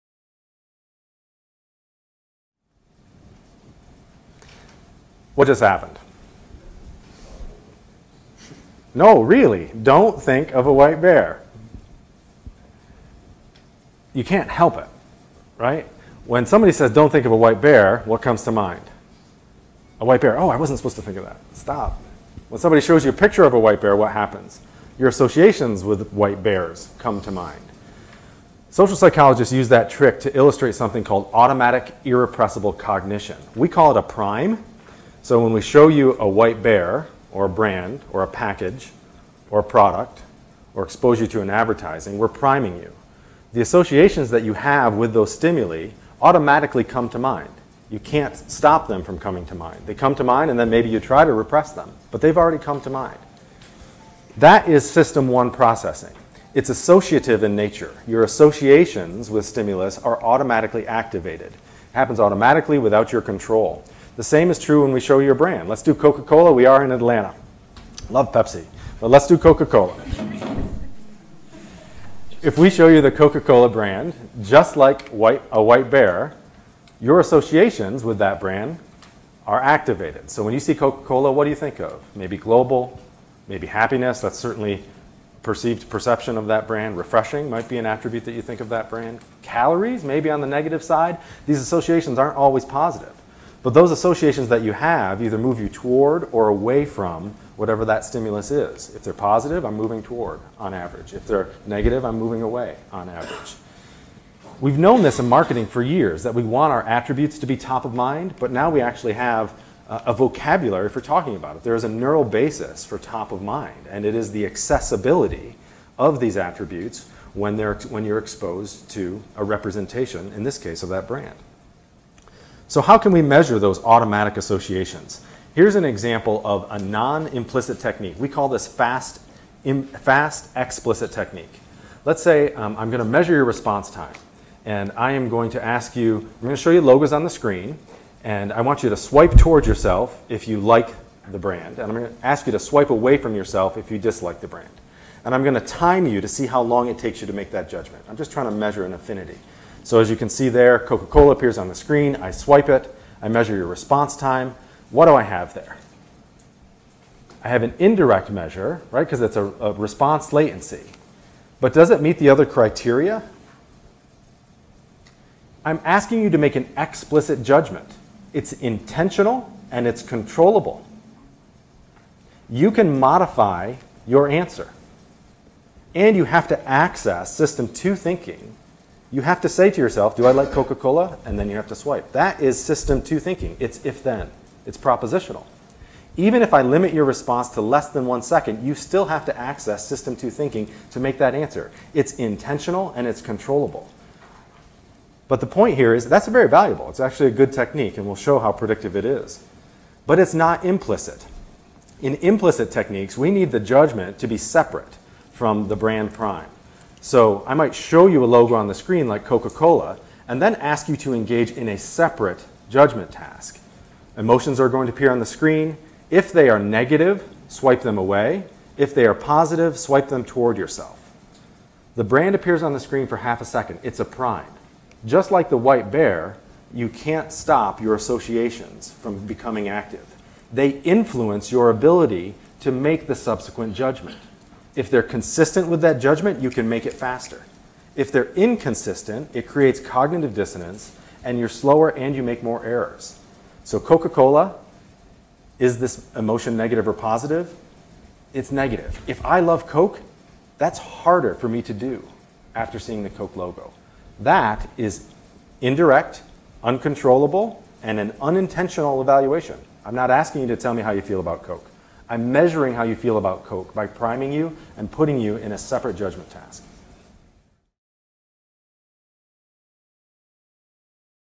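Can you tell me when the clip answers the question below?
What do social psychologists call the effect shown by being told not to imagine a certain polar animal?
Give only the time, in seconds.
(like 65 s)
31 s.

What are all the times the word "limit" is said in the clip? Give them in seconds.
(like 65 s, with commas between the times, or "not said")
186 s.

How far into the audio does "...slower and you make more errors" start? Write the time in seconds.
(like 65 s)
241 s.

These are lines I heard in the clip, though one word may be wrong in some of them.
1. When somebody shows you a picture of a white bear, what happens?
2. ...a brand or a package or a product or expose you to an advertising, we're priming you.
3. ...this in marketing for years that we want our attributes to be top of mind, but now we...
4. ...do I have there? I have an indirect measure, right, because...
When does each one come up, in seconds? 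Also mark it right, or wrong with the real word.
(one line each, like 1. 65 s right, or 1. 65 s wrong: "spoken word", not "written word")
1. 22 s right
2. 37 s right
3. 105 s right
4. 155 s right.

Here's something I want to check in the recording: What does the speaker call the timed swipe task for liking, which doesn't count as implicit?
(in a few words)
fast explicit technique.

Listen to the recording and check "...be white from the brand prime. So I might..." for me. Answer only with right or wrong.
wrong.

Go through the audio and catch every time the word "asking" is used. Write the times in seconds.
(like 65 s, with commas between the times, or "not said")
165 s, 260 s.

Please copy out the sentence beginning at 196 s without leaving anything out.
It's actually a good technique, and we'll show how predictive it is.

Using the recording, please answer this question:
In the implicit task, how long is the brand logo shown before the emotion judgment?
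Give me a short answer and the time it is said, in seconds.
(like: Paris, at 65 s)
half a second, at 223 s.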